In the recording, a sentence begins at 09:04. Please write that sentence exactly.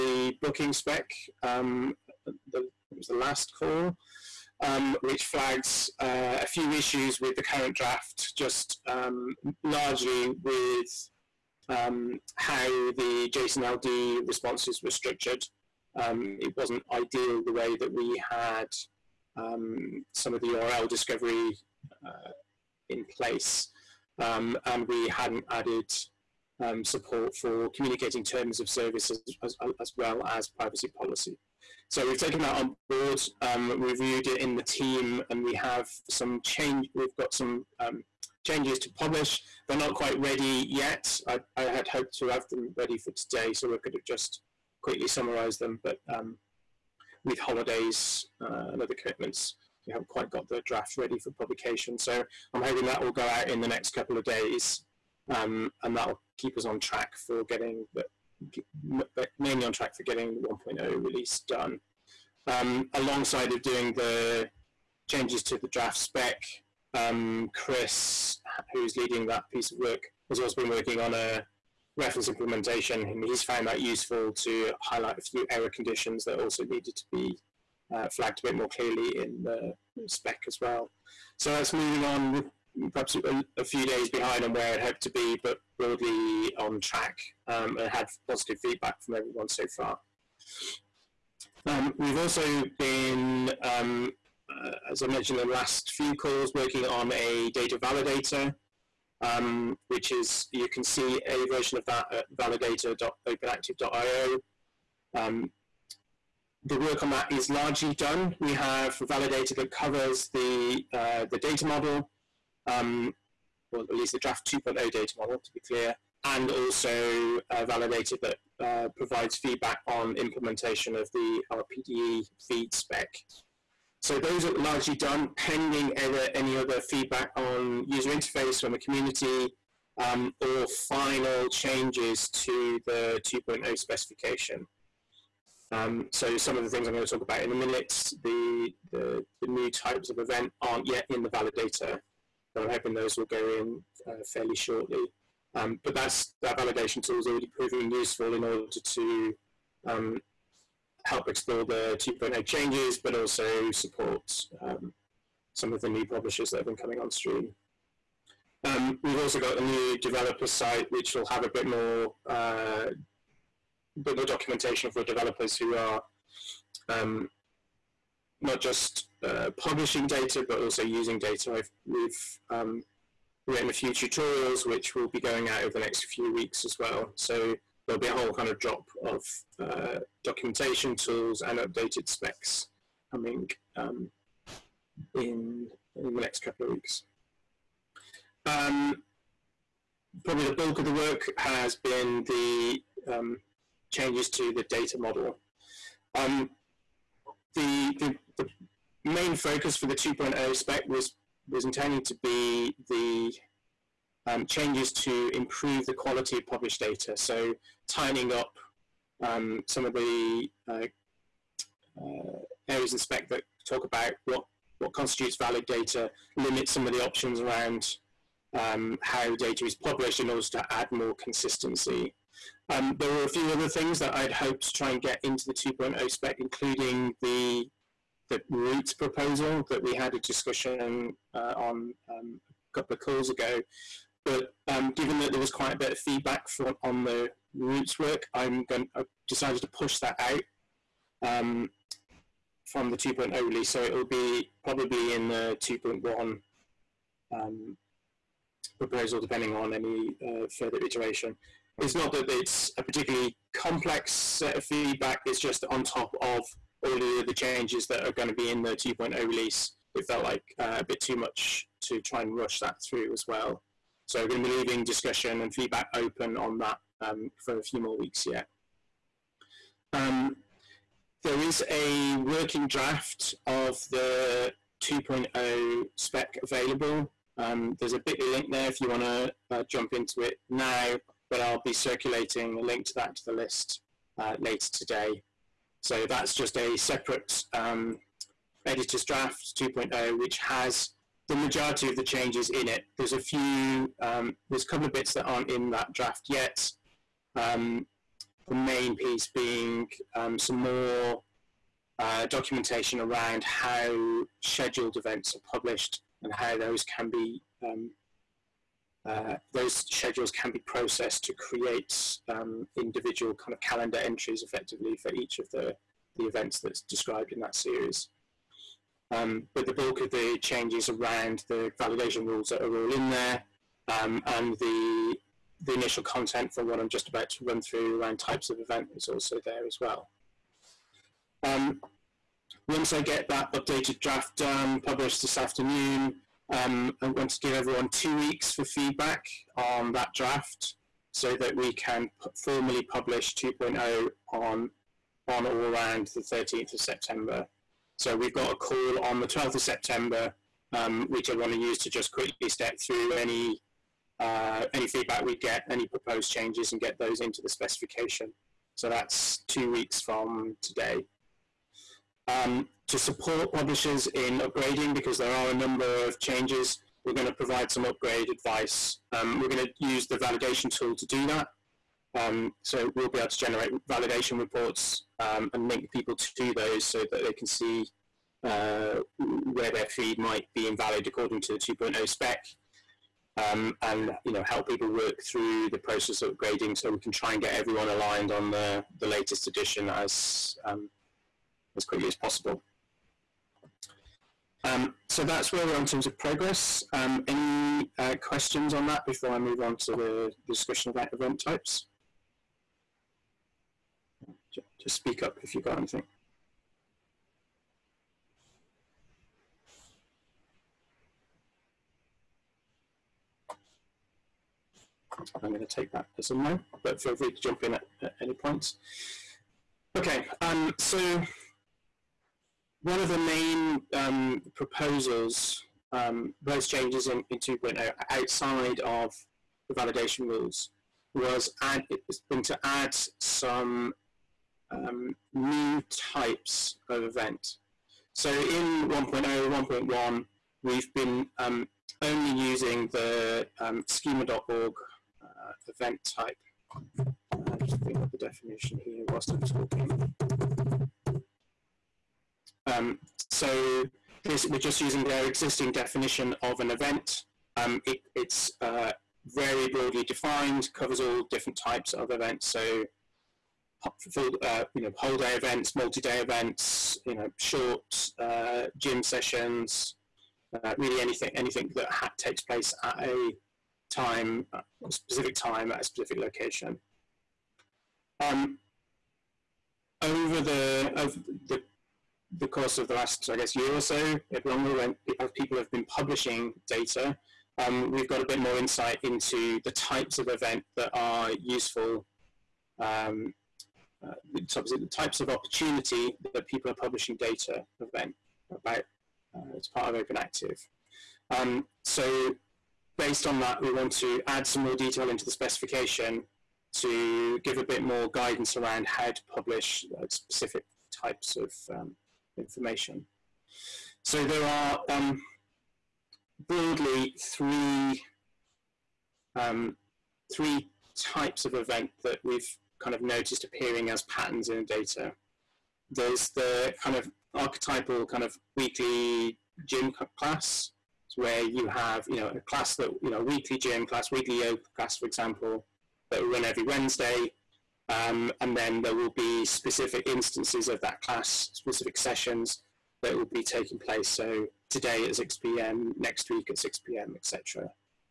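So today at 6 p.m., next week at 6 p.m., etc.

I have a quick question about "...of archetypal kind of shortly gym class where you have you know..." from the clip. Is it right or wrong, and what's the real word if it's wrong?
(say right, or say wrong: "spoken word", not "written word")
wrong: "weekly", not "shortly".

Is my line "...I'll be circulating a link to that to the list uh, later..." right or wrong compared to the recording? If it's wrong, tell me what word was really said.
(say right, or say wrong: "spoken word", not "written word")
right.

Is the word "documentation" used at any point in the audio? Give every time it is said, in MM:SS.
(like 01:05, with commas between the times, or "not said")
02:44, 03:00, 05:02.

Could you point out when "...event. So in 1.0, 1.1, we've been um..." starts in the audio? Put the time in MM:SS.
07:17.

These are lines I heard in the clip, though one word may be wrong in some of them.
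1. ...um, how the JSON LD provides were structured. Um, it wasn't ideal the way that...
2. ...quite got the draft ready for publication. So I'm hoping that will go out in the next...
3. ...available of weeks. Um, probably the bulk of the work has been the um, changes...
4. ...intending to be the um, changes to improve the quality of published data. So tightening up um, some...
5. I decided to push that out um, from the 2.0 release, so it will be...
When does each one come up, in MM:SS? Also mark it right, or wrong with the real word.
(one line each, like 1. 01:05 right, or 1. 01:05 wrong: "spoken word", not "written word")
1. 00:11 wrong: "responses", not "provides"
2. 00:50 right
3. 03:06 wrong: "couple", not "available"
4. 03:21 right
5. 03:58 right.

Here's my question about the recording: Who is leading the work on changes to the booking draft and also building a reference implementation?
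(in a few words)
Chris.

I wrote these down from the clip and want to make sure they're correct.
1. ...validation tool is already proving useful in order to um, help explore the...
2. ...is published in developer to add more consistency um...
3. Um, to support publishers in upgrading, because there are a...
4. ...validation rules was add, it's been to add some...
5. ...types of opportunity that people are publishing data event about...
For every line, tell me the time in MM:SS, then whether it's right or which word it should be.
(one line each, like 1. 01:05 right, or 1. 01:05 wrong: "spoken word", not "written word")
1. 02:26 right
2. 03:39 wrong: "order", not "developer"
3. 06:02 right
4. 07:09 right
5. 08:14 right.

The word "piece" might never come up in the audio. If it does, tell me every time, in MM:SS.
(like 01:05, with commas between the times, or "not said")
01:09, 04:58.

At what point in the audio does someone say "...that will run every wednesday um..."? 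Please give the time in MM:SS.
08:56.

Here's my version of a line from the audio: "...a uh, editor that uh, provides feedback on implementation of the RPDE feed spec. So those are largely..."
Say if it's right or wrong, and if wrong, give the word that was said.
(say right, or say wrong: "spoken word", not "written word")
wrong: "validator", not "editor".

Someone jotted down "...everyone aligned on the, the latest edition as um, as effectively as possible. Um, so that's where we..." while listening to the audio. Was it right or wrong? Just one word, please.
wrong.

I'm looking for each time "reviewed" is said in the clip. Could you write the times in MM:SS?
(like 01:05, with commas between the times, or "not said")
00:33.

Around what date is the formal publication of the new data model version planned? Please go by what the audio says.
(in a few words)
13th of September.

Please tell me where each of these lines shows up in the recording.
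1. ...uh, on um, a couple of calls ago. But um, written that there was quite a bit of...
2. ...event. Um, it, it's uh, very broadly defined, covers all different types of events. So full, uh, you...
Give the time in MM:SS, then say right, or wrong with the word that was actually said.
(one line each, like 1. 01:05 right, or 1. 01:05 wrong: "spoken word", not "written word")
1. 03:51 wrong: "given", not "written"
2. 07:36 right.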